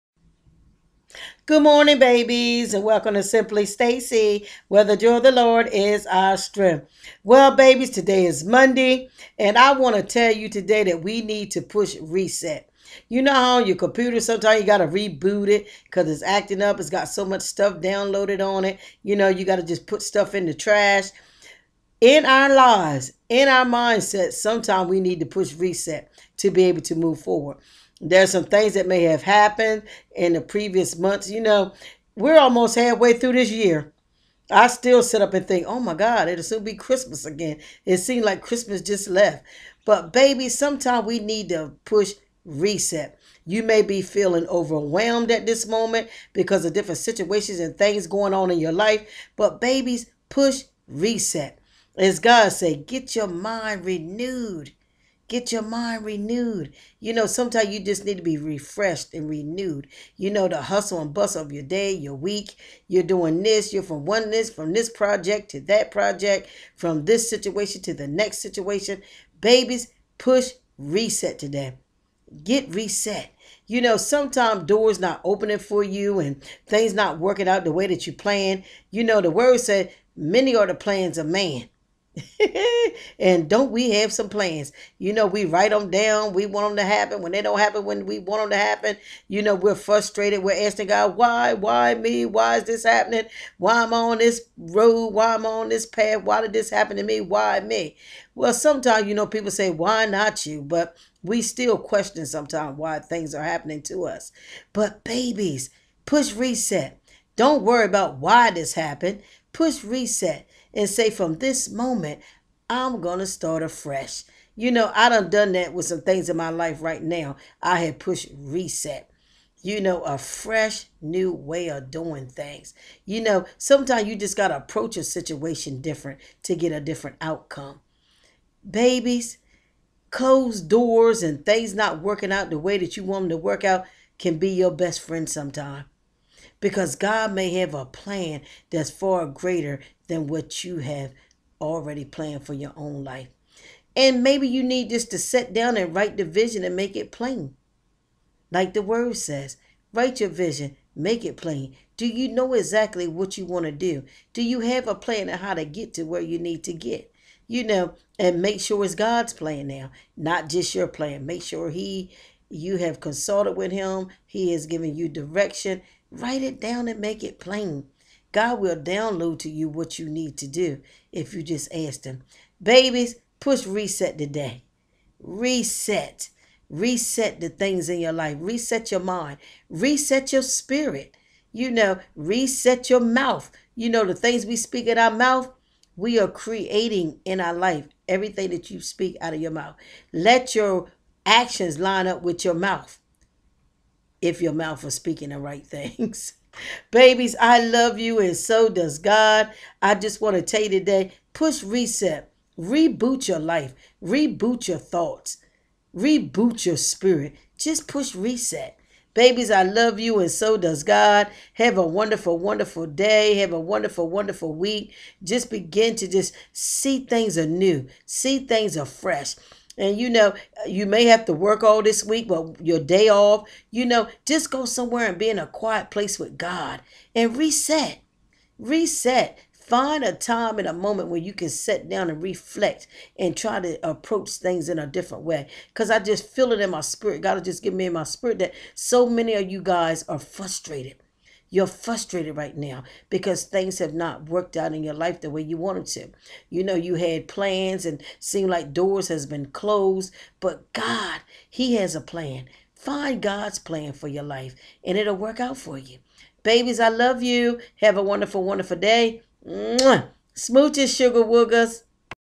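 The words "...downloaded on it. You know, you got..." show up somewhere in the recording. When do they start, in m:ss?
0:17.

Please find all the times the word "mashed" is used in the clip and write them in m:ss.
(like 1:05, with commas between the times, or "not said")
not said.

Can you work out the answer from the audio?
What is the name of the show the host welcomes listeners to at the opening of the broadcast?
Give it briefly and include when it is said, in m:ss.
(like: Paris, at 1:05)
Simply Stacey, at 0:03.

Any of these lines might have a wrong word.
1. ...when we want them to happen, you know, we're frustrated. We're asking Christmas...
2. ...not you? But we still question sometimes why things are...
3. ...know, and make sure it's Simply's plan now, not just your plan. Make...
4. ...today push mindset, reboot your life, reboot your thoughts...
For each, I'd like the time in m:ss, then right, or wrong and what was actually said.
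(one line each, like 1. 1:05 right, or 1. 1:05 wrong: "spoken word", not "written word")
1. 1:27 wrong: "God", not "Christmas"
2. 1:40 right
3. 2:37 wrong: "God", not "Simply"
4. 3:20 wrong: "reset", not "mindset".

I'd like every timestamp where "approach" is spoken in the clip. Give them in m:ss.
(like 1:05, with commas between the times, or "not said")
2:04, 3:53.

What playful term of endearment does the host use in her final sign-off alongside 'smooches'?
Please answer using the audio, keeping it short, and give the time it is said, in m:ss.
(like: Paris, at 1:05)
sugar woogers, at 4:20.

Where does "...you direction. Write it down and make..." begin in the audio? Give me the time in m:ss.
2:44.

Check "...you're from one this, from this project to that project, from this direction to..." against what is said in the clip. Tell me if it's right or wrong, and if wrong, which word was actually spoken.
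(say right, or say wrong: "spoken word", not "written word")
wrong: "situation", not "direction".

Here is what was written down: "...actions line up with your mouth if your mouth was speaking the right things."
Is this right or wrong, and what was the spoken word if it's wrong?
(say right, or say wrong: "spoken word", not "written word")
right.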